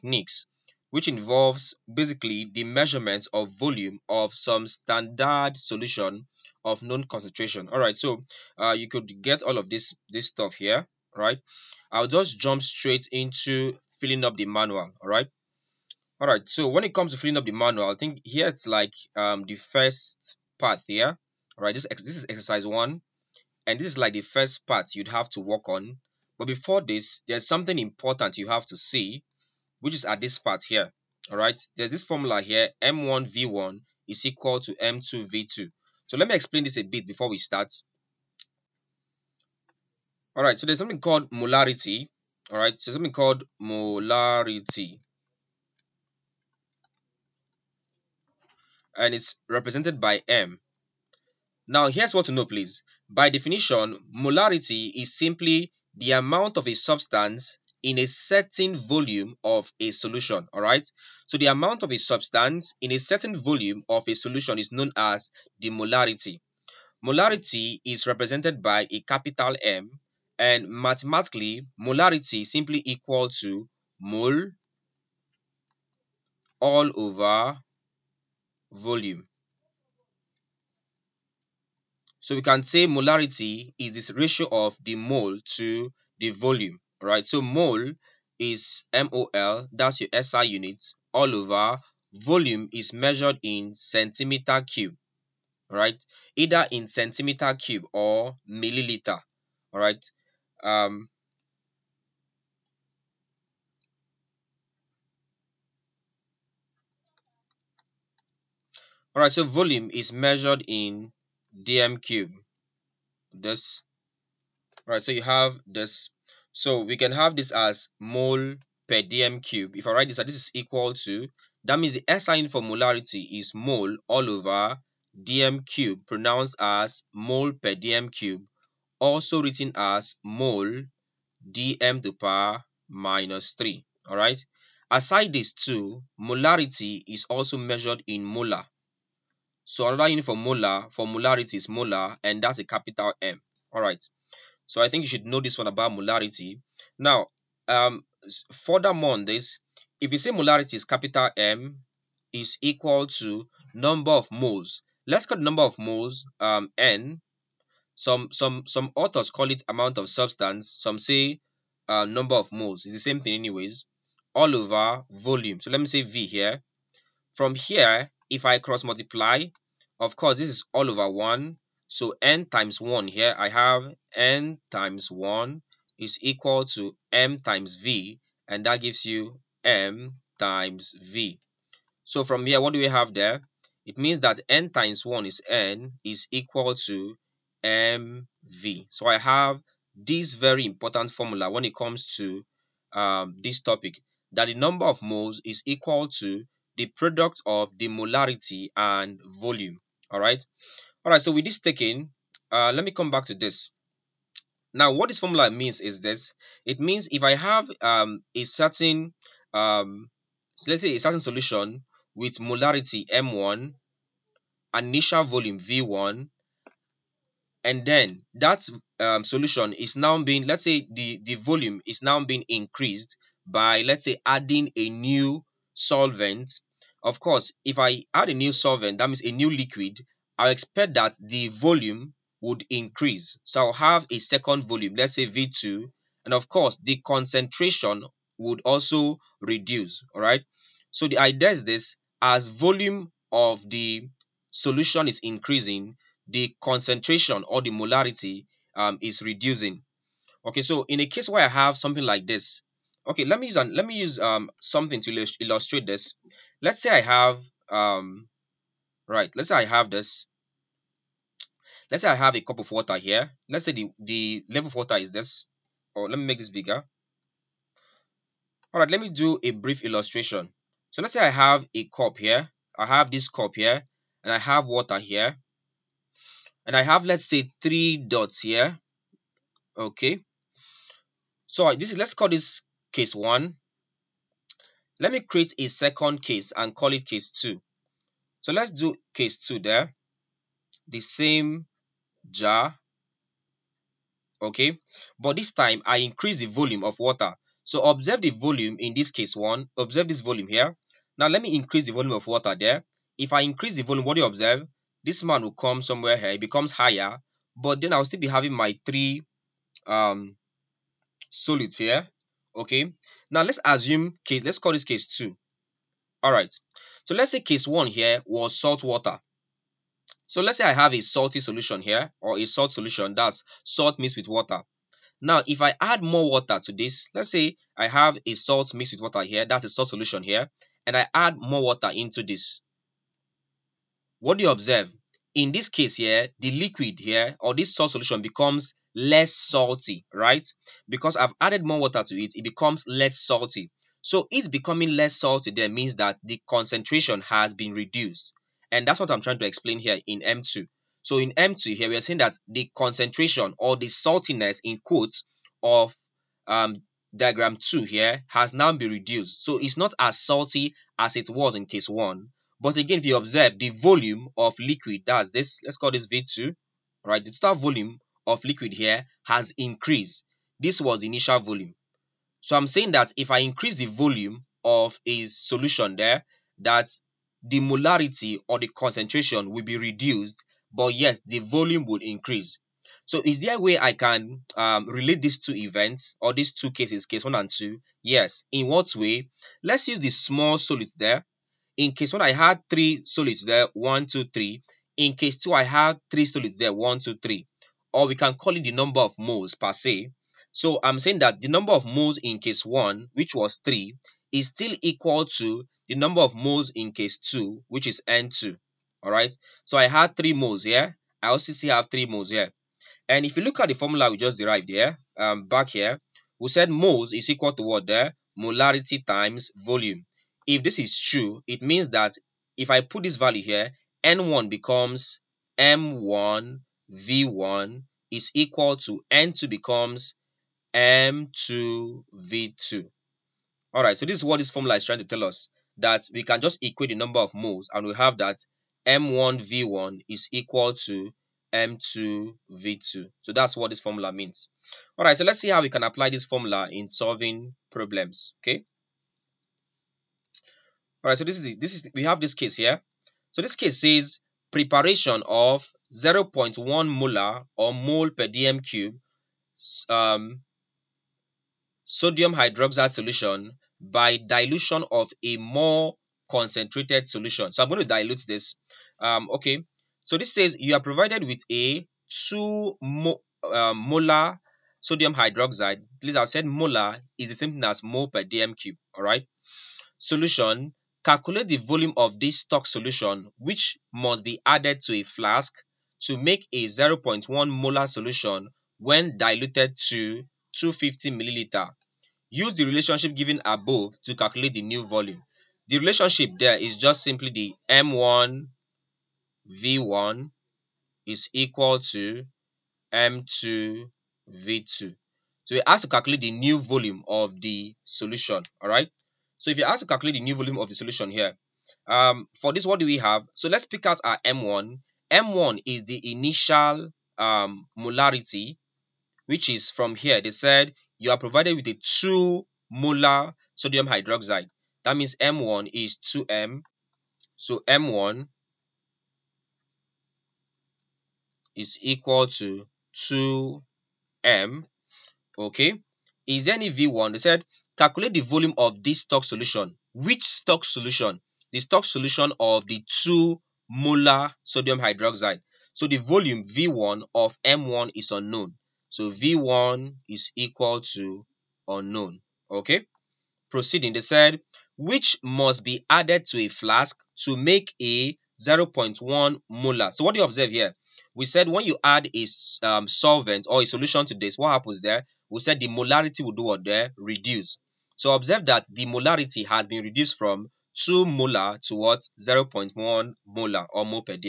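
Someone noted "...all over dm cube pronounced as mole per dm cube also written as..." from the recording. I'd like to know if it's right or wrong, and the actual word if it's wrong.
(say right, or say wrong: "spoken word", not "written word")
right.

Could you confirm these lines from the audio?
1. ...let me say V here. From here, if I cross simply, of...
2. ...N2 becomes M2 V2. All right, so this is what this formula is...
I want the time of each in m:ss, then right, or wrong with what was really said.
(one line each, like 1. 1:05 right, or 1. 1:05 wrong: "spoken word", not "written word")
1. 2:45 wrong: "multiply", not "simply"
2. 7:09 right.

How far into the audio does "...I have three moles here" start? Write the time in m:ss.
6:51.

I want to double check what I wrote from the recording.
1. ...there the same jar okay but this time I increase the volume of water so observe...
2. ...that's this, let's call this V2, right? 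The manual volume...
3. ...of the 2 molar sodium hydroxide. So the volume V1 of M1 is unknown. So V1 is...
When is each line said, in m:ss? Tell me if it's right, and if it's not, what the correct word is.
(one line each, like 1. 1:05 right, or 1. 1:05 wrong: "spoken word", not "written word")
1. 4:49 right
2. 6:05 wrong: "total", not "manual"
3. 9:02 right.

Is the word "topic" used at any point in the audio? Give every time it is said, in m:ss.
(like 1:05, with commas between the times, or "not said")
3:13.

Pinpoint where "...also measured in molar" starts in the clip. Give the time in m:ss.
2:17.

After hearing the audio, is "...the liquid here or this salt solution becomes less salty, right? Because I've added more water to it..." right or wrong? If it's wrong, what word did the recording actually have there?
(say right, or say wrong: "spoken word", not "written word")
right.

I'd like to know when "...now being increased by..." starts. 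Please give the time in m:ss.
3:42.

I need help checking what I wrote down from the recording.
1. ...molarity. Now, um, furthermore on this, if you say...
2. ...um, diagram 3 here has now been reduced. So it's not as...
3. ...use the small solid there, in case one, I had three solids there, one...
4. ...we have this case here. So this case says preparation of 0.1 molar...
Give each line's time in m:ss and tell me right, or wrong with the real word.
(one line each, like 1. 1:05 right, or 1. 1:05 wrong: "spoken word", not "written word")
1. 2:25 right
2. 5:56 wrong: "2", not "3"
3. 6:29 right
4. 7:31 right.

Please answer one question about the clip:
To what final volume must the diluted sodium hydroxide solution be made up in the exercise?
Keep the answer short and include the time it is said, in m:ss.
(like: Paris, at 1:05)
250 milliliters, at 8:10.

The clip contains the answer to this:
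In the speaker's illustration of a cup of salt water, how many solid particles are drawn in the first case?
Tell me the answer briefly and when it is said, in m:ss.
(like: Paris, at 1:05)
3, at 4:37.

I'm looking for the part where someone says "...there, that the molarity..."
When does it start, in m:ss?
6:15.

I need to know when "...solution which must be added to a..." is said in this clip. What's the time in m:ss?
8:02.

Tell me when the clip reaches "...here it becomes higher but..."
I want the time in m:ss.
5:06.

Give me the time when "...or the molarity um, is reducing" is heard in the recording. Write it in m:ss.
4:07.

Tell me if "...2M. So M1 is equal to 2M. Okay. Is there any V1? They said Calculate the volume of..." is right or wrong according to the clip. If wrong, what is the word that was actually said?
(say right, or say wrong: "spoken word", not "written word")
right.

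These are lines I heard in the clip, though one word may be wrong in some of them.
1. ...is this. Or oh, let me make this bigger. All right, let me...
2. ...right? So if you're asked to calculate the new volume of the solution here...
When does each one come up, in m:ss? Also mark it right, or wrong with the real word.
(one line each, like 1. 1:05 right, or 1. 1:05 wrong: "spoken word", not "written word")
1. 4:24 right
2. 8:28 right.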